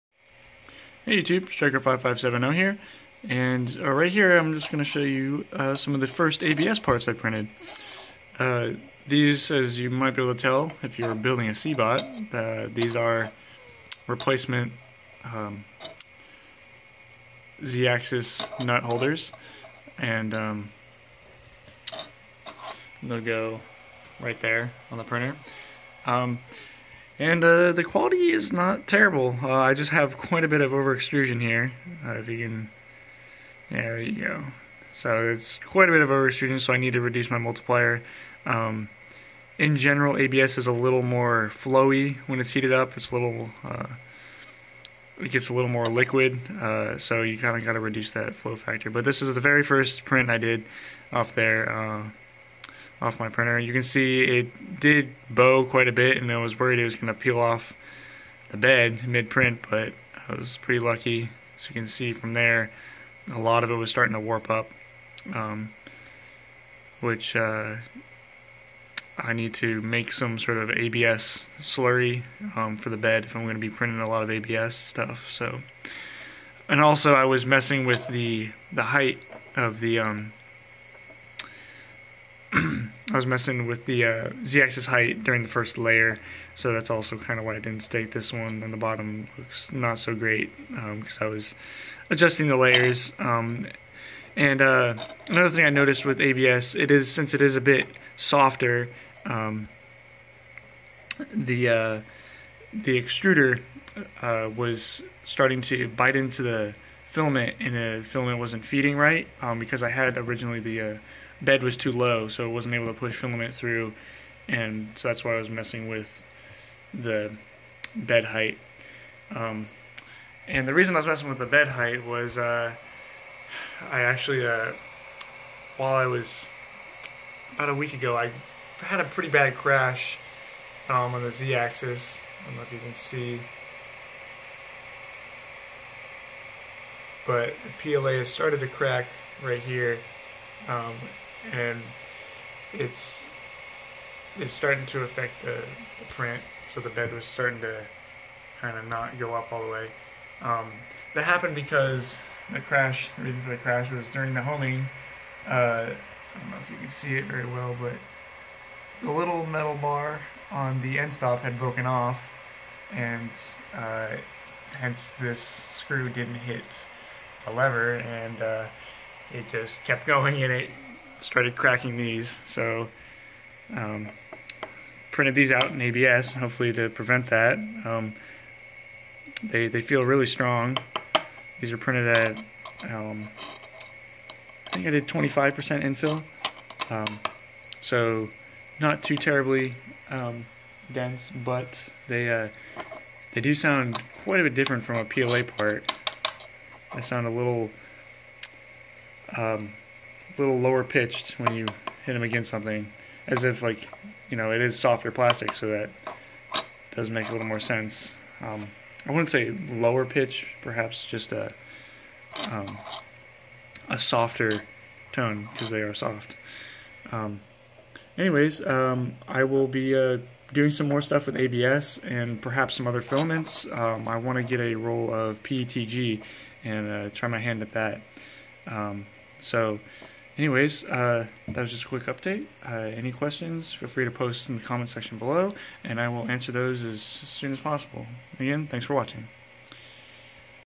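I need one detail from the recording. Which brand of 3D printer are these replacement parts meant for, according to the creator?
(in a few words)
CBOT.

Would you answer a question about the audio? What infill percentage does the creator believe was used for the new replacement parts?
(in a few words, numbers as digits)
25%.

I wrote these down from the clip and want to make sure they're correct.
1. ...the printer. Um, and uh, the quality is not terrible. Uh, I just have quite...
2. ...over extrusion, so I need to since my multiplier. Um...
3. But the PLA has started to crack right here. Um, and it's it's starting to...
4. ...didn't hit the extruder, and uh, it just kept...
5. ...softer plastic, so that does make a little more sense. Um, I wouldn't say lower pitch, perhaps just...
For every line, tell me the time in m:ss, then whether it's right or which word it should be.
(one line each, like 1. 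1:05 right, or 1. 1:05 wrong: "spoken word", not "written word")
1. 0:24 right
2. 0:36 wrong: "reduce", not "since"
3. 2:17 right
4. 2:46 wrong: "lever", not "extruder"
5. 3:24 right.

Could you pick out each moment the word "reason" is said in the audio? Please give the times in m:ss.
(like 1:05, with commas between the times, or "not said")
2:00, 2:33.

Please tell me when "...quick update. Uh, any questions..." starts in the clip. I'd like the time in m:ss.
3:51.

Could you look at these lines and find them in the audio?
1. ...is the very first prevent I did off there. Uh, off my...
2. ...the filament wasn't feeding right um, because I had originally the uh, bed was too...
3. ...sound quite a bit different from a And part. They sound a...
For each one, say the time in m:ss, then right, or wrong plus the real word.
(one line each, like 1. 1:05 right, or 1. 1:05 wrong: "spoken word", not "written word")
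1. 0:49 wrong: "print", not "prevent"
2. 1:47 right
3. 3:13 wrong: "PLA", not "And".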